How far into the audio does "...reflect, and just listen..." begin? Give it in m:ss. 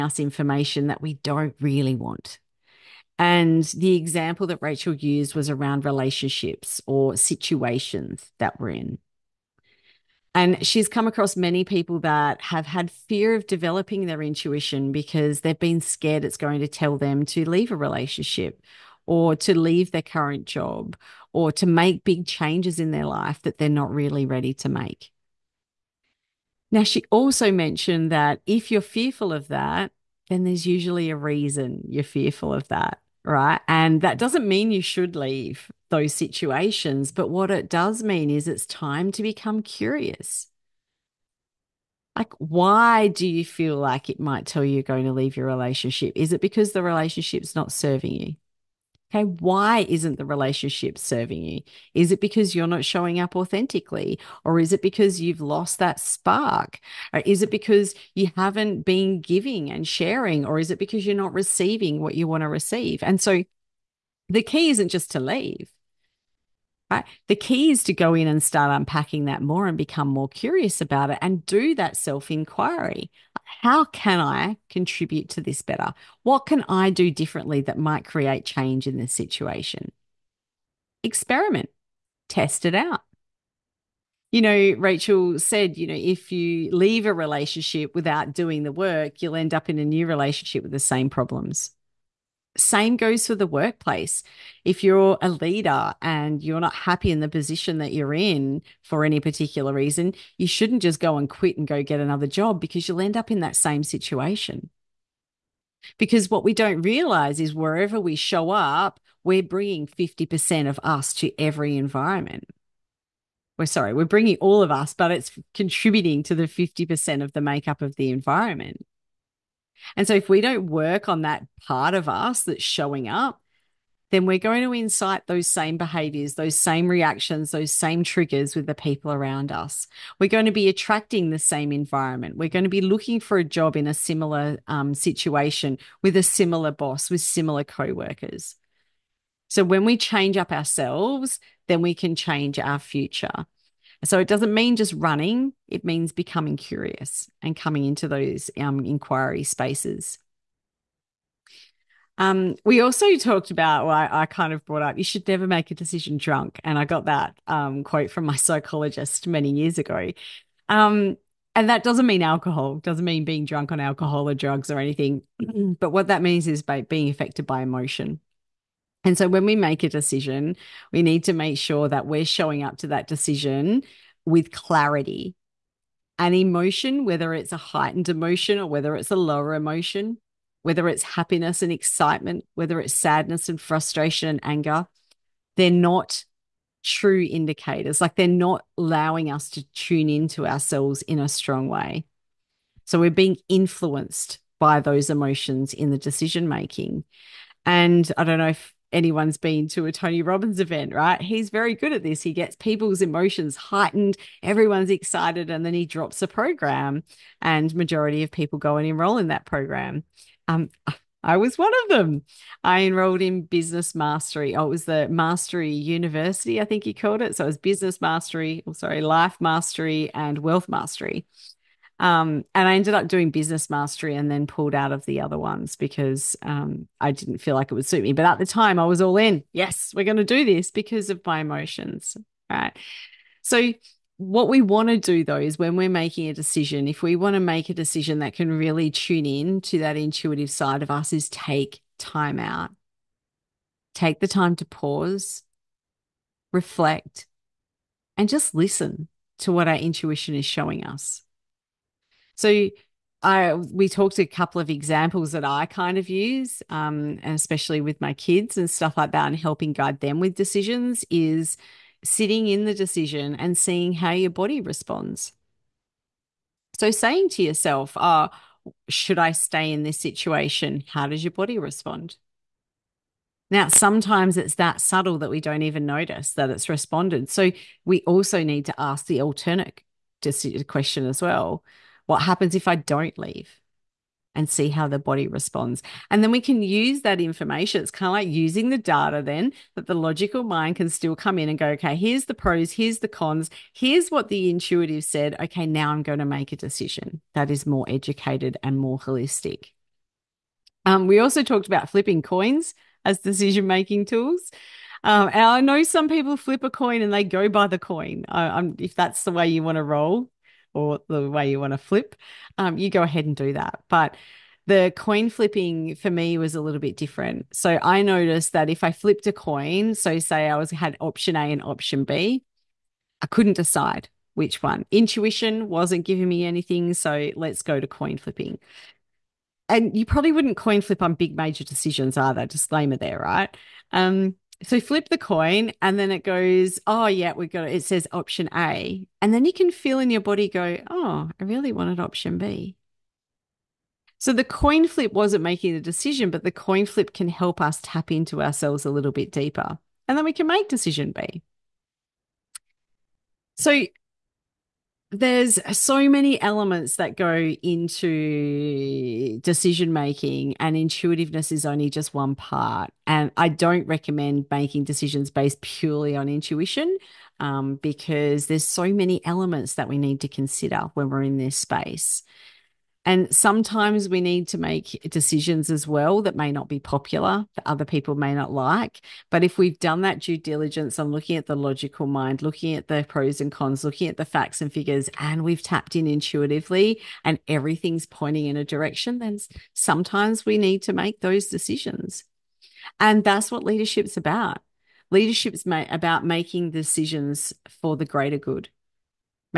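4:06.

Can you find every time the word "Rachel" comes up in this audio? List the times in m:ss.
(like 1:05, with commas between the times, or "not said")
0:04, 1:24.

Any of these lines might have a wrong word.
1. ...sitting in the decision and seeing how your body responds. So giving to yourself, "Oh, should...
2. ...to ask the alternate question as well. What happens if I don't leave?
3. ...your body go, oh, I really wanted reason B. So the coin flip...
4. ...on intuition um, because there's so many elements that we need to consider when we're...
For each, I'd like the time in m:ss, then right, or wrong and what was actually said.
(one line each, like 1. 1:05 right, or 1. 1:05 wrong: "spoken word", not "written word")
1. 4:22 wrong: "saying", not "giving"
2. 4:38 right
3. 5:40 wrong: "option", not "reason"
4. 6:06 right.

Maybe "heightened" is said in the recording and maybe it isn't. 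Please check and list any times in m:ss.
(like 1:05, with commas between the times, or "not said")
2:57, 3:23.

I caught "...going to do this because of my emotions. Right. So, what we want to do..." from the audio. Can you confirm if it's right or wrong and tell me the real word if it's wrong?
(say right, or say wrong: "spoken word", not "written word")
right.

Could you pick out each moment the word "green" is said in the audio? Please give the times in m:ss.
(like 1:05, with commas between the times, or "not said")
not said.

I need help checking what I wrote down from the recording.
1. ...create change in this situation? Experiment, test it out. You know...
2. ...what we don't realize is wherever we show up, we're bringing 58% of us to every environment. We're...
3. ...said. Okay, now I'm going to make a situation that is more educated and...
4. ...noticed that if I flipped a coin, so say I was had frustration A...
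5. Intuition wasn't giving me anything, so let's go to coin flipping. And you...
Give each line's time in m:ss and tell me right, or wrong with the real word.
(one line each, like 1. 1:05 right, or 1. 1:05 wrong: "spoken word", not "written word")
1. 1:18 right
2. 1:46 wrong: "50", not "58"
3. 4:55 wrong: "decision", not "situation"
4. 5:18 wrong: "option", not "frustration"
5. 5:24 right.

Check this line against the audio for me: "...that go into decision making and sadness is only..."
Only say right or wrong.
wrong.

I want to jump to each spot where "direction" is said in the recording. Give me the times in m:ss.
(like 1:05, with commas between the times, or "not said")
6:28.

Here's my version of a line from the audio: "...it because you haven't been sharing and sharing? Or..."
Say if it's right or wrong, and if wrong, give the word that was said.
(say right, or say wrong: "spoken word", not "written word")
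wrong: "giving", not "sharing".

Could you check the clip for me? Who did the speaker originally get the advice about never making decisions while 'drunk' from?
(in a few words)
psychologist.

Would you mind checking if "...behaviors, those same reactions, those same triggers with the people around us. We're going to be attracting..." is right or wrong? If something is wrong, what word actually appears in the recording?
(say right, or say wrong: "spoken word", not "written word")
right.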